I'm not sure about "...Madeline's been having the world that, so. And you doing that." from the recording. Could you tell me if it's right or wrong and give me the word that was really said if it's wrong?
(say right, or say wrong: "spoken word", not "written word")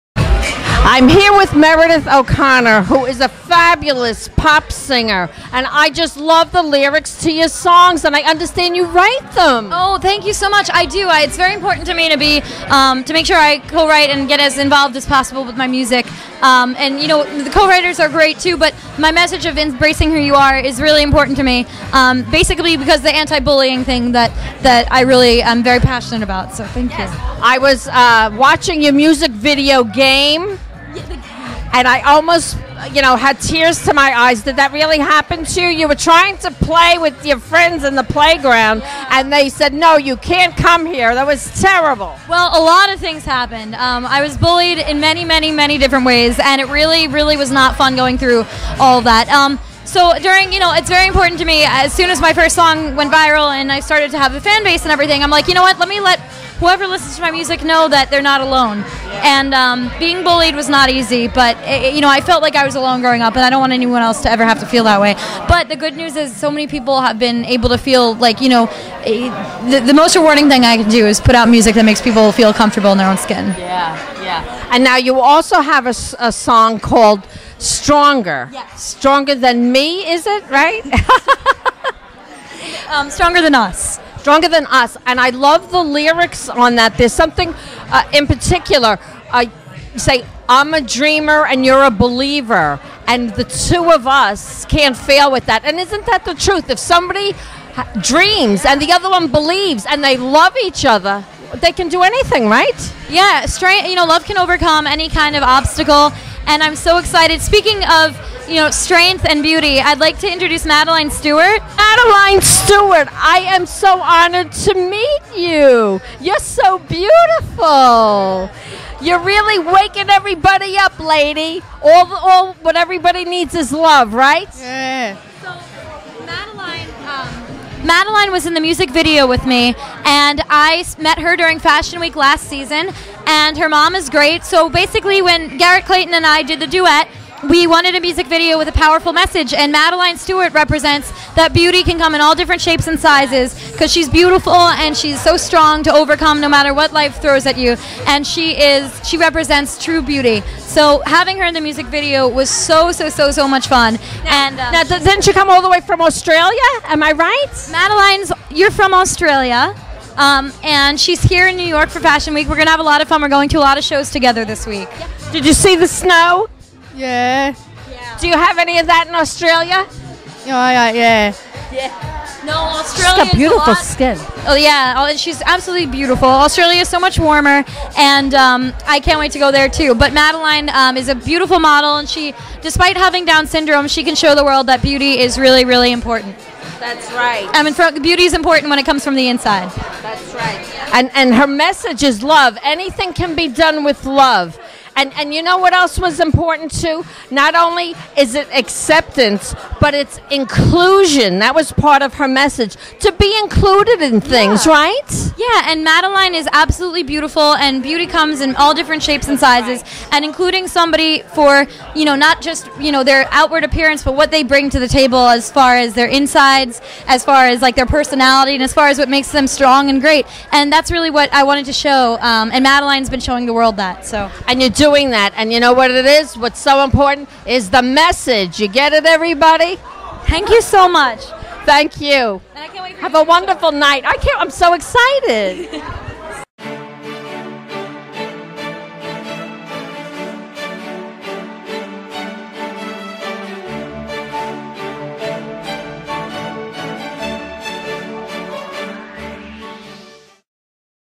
wrong: "showing", not "having".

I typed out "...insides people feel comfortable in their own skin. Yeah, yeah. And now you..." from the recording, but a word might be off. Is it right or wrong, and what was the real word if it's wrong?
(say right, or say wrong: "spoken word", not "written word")
wrong: "makes", not "insides".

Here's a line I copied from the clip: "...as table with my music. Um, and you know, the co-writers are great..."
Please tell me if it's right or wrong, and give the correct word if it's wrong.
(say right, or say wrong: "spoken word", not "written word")
wrong: "possible", not "table".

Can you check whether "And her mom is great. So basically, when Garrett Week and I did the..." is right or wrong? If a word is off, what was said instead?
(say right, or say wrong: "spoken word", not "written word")
wrong: "Clayton", not "Week".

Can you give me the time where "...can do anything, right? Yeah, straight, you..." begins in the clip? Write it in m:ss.
1:41.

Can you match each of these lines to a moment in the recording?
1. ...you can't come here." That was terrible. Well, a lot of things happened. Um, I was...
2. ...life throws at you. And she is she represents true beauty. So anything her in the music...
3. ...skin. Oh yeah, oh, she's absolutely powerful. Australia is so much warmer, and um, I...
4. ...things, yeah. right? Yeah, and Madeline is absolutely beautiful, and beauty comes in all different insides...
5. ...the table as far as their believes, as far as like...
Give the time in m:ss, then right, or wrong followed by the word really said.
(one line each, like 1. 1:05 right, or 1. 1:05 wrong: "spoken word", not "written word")
1. 0:39 right
2. 2:26 wrong: "having", not "anything"
3. 2:53 wrong: "beautiful", not "powerful"
4. 3:24 wrong: "shapes", not "insides"
5. 3:34 wrong: "insides", not "believes".